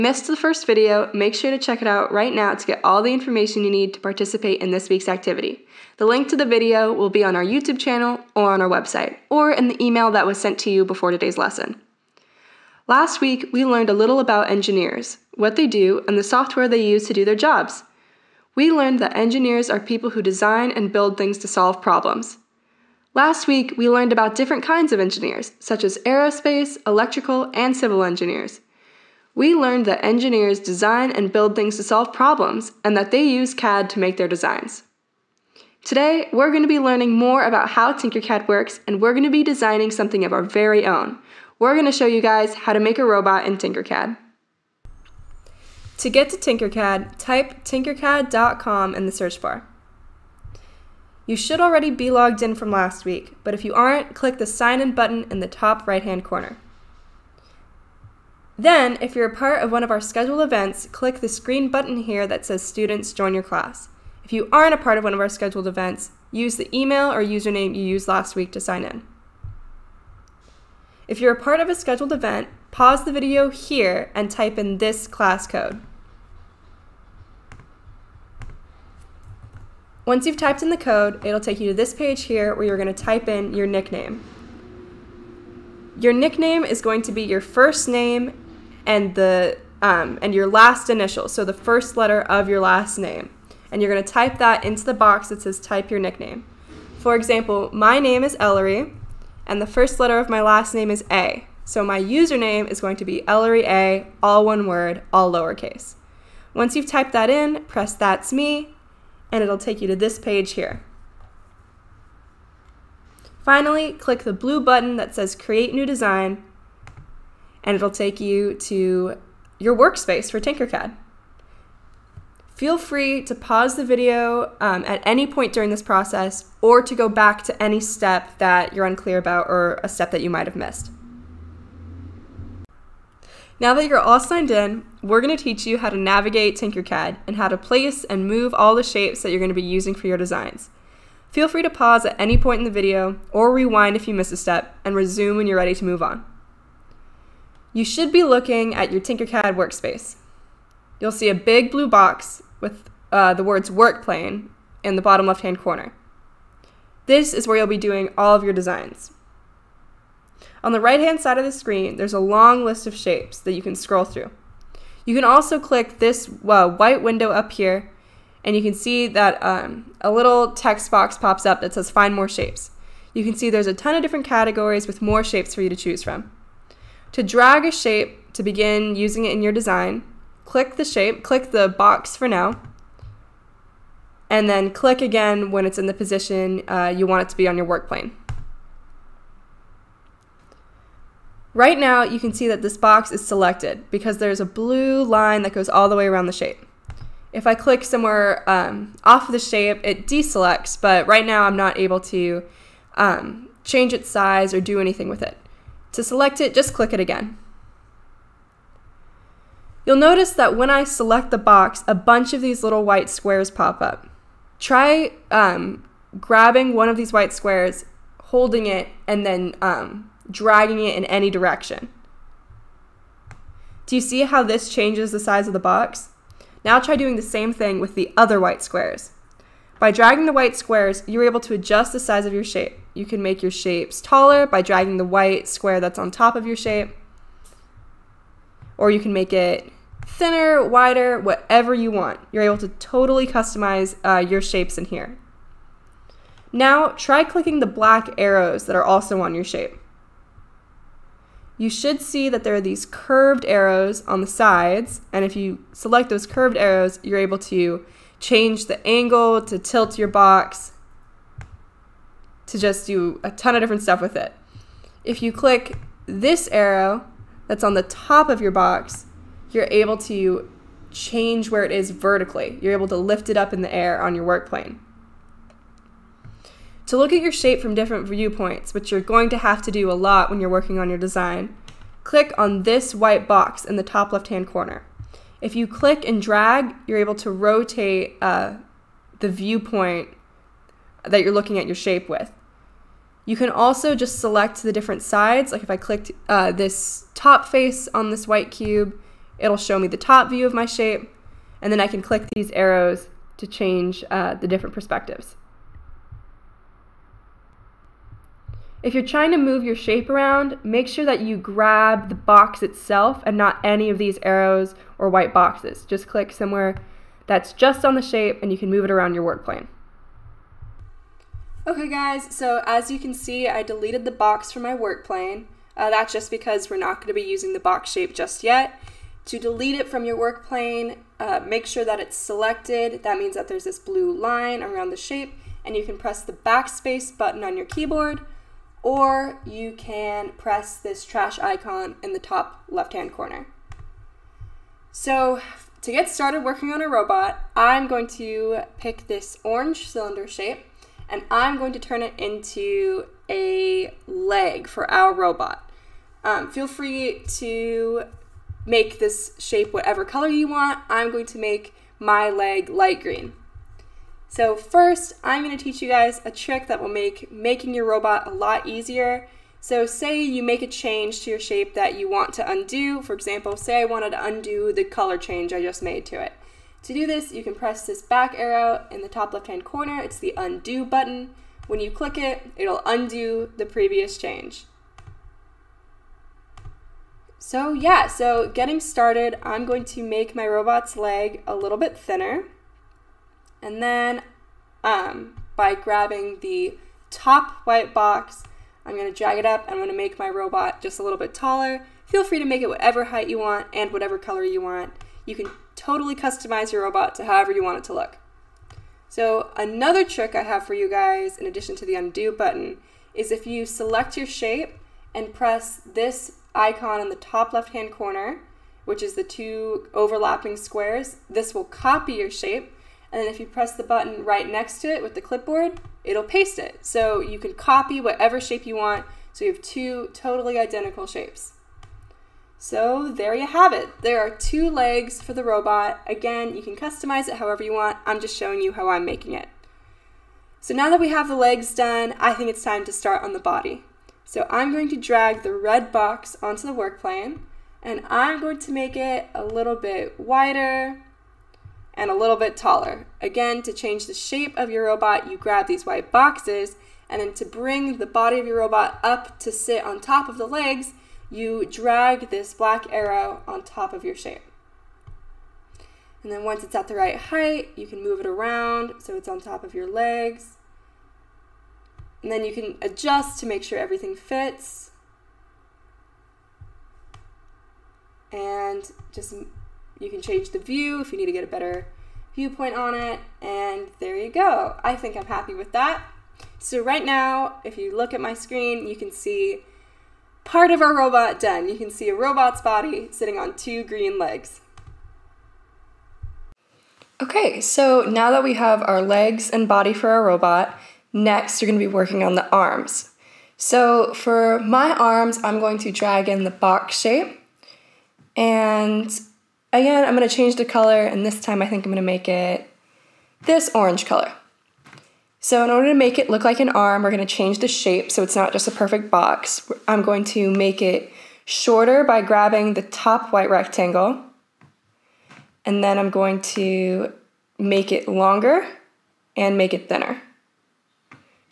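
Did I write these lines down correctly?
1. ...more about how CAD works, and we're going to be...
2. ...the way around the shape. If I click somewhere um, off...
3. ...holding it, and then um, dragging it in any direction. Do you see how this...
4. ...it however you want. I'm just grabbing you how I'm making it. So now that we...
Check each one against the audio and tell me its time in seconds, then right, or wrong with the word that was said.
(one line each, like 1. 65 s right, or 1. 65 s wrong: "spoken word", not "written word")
1. 37 s wrong: "Tinkercad", not "CAD"
2. 195 s right
3. 218 s right
4. 437 s wrong: "showing", not "grabbing".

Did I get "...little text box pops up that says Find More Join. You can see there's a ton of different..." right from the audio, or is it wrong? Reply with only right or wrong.
wrong.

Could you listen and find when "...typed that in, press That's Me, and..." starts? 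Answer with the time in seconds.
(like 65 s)
106 s.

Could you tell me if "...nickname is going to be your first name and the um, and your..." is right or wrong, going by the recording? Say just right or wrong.
right.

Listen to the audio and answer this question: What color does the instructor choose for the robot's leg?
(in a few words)
light green.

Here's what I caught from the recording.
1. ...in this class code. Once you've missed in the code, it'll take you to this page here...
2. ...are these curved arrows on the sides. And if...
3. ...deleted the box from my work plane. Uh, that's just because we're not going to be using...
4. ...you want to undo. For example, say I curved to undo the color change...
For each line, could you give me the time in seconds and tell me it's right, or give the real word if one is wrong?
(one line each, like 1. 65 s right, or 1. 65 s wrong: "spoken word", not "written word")
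1. 74 s wrong: "typed", not "missed"
2. 252 s right
3. 323 s right
4. 371 s wrong: "wanted", not "curved".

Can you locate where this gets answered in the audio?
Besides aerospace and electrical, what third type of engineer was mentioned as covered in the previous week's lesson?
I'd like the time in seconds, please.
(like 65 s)
27 s.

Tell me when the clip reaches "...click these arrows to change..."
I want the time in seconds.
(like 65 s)
302 s.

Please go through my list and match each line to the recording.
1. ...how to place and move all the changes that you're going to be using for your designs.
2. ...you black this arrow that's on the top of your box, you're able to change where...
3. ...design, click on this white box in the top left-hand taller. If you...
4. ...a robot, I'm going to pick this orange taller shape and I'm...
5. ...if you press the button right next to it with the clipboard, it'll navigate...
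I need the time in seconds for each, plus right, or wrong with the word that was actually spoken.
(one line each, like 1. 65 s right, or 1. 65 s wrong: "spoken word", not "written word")
1. 137 s wrong: "shapes", not "changes"
2. 265 s wrong: "click", not "black"
3. 280 s wrong: "corner", not "taller"
4. 346 s wrong: "cylinder", not "taller"
5. 423 s wrong: "paste", not "navigate".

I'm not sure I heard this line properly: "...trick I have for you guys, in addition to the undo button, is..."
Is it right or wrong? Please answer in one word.
right.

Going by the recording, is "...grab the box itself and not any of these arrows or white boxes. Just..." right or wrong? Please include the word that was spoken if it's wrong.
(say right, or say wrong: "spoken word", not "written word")
right.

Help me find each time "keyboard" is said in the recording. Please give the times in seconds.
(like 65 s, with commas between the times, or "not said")
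337 s.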